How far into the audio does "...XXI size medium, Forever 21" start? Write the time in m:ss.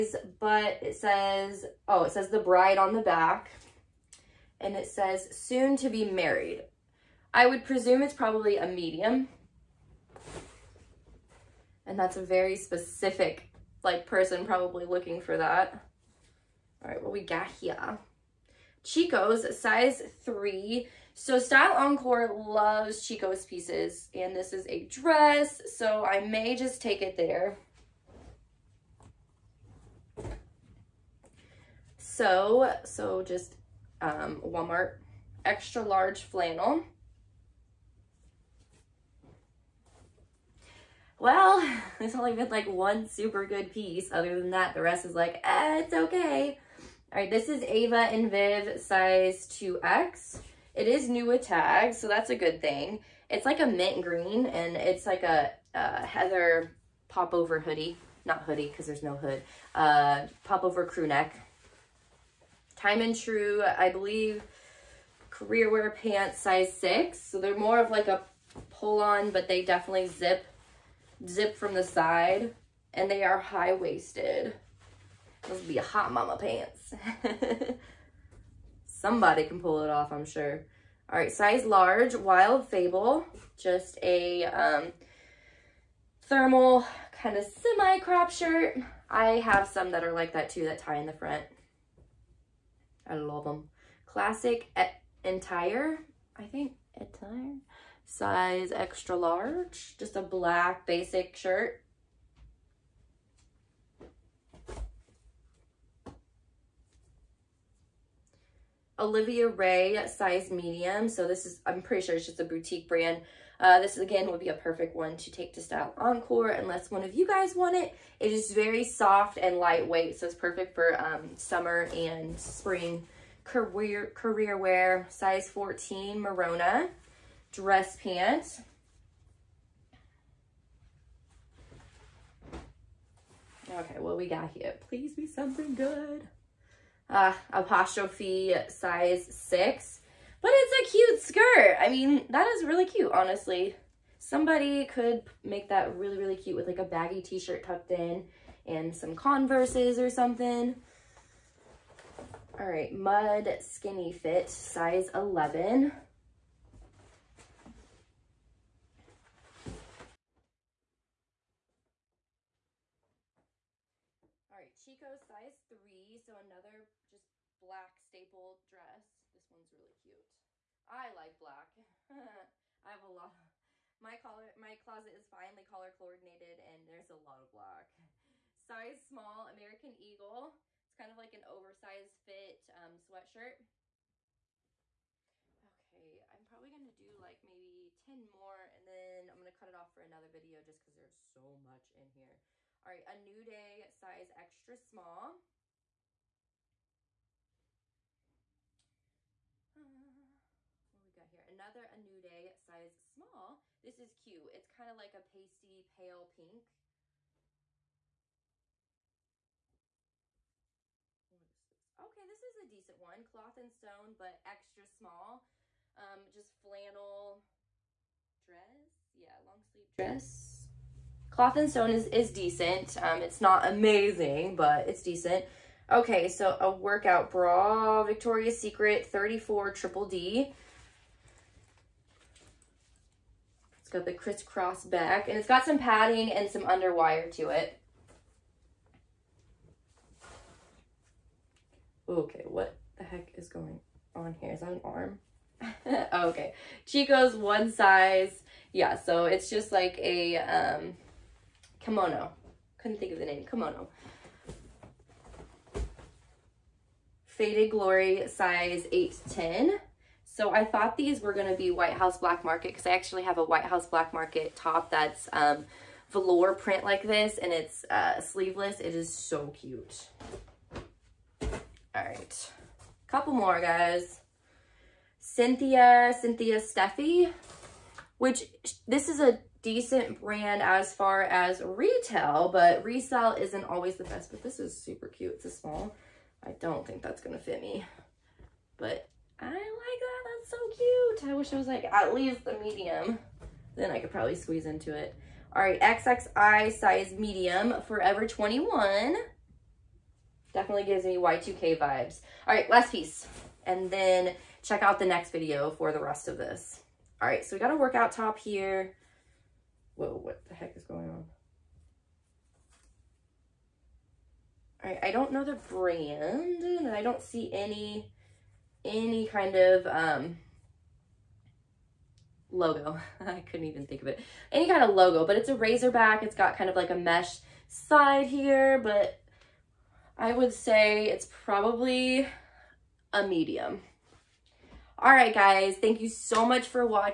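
4:55.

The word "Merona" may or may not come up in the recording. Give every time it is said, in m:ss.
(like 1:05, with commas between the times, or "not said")
2:06.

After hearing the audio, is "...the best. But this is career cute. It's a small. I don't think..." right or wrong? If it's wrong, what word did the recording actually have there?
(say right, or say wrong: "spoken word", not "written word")
wrong: "super", not "career".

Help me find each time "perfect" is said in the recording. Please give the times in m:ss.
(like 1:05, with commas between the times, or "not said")
1:54, 2:00.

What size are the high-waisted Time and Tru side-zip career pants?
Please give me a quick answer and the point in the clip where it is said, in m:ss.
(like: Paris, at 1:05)
6, at 1:06.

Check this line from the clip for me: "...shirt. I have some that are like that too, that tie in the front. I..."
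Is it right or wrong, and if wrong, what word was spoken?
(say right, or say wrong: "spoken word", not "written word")
right.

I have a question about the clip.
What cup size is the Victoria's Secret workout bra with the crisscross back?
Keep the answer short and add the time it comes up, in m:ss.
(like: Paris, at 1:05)
34 Triple D, at 3:49.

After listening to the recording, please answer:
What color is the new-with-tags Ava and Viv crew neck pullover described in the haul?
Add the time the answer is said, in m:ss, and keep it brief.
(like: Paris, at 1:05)
mint green, at 0:53.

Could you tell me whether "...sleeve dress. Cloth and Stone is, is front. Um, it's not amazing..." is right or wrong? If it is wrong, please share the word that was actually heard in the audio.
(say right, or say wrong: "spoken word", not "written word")
wrong: "decent", not "front".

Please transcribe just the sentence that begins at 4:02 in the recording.
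Okay, what the heck is going on here?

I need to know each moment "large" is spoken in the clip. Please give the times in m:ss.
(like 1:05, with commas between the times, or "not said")
0:35, 1:21, 1:39.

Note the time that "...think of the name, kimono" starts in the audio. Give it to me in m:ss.
4:12.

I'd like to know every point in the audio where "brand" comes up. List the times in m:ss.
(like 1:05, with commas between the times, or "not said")
1:52, 4:40, 5:15.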